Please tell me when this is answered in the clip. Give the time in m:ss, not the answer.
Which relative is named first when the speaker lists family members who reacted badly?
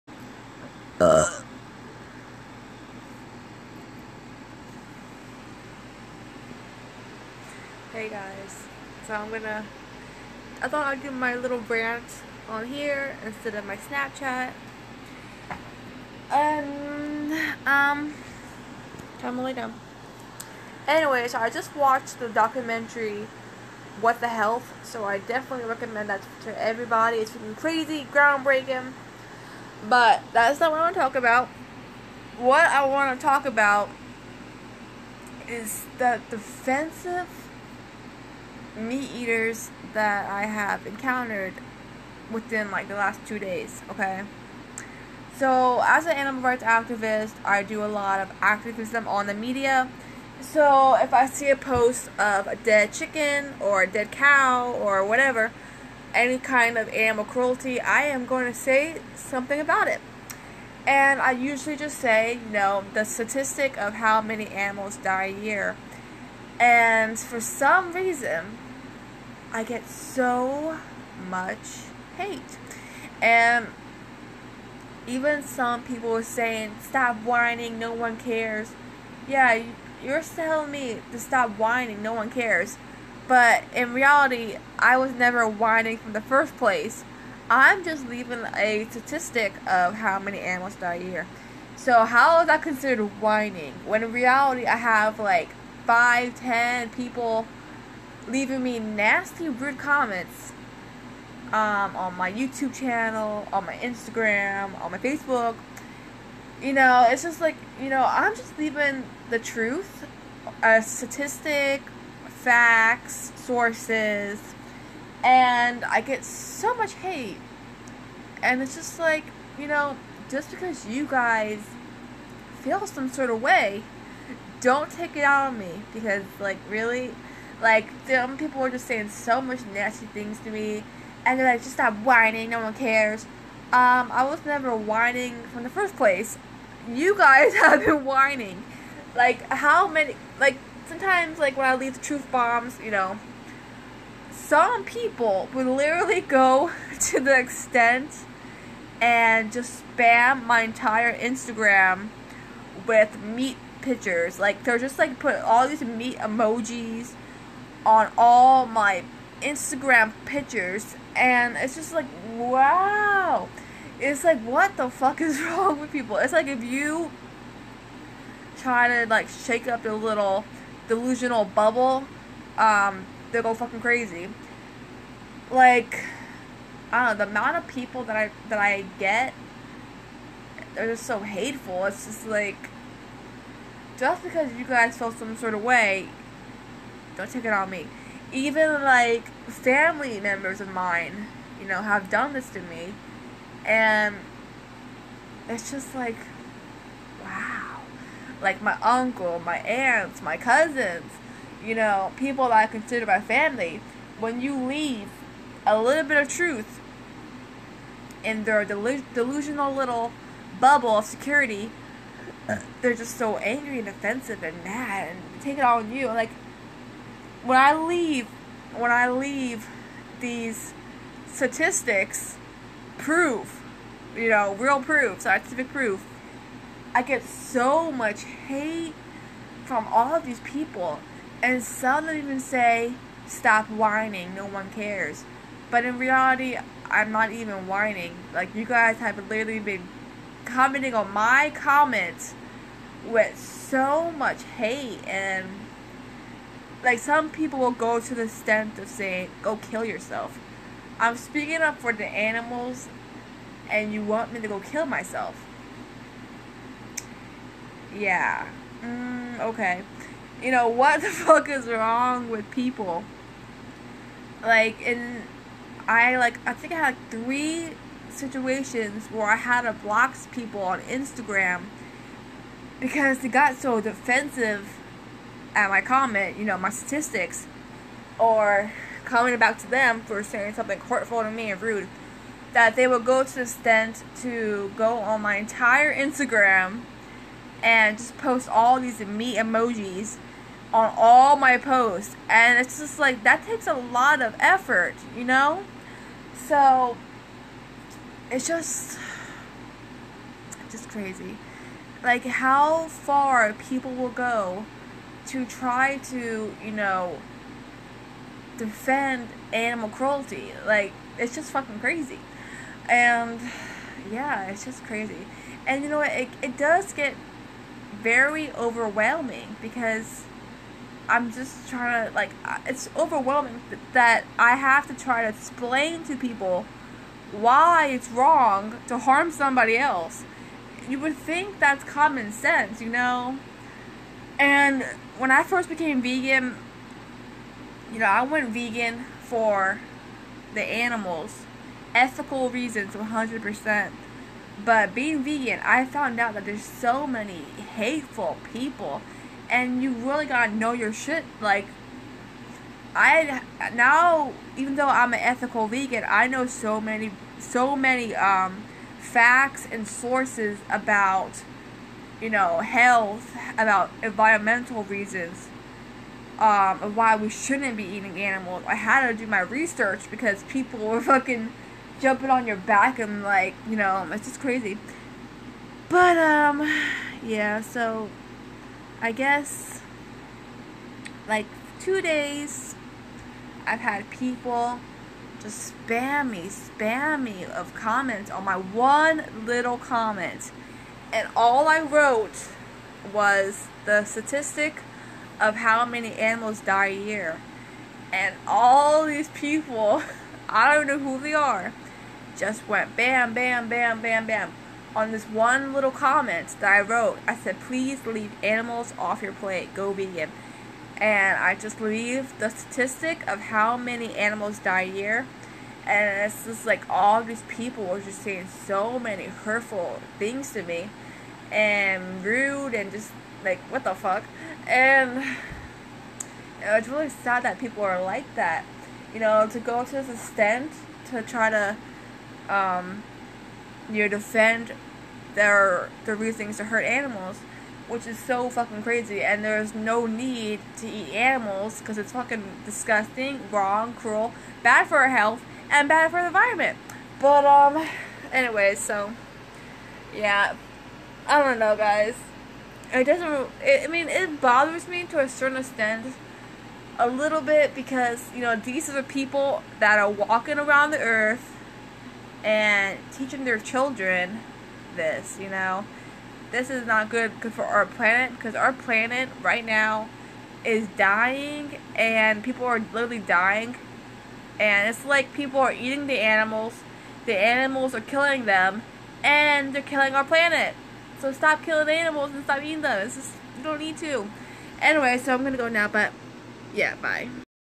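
3:18.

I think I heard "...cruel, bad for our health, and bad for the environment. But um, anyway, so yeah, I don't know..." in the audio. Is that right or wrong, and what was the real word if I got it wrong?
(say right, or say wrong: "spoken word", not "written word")
right.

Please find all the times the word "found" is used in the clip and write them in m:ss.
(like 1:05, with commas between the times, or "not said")
5:45.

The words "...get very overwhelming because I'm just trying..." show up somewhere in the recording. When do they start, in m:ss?
5:16.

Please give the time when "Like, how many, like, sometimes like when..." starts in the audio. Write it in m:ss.
2:19.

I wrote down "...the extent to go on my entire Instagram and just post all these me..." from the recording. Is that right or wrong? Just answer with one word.
right.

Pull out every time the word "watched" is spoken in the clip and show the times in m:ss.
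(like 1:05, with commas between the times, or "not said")
0:21.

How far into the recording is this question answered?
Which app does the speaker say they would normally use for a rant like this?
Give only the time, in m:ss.
0:13.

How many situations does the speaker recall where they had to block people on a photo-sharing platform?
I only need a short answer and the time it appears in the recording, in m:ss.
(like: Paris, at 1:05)
3, at 4:27.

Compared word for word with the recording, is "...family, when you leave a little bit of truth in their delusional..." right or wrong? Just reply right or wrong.
right.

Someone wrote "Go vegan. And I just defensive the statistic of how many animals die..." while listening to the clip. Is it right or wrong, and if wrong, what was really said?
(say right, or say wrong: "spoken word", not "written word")
wrong: "leave", not "defensive".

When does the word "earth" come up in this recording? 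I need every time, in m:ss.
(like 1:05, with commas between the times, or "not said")
7:40.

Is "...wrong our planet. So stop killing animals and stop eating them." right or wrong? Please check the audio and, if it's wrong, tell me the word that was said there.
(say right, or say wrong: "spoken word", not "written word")
wrong: "killing", not "wrong".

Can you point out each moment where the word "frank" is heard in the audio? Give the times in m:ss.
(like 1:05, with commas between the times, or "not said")
not said.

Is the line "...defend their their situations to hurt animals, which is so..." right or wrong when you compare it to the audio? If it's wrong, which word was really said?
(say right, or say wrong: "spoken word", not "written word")
wrong: "reasons", not "situations".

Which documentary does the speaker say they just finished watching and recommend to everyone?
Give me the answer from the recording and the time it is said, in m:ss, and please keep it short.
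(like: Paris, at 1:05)
What the Health, at 0:24.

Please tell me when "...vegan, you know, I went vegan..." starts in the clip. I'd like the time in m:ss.
5:36.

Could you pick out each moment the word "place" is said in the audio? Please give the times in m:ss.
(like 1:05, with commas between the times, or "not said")
1:26, 2:15.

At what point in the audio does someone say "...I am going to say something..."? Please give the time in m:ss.
0:57.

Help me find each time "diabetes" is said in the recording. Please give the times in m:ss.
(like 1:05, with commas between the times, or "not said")
not said.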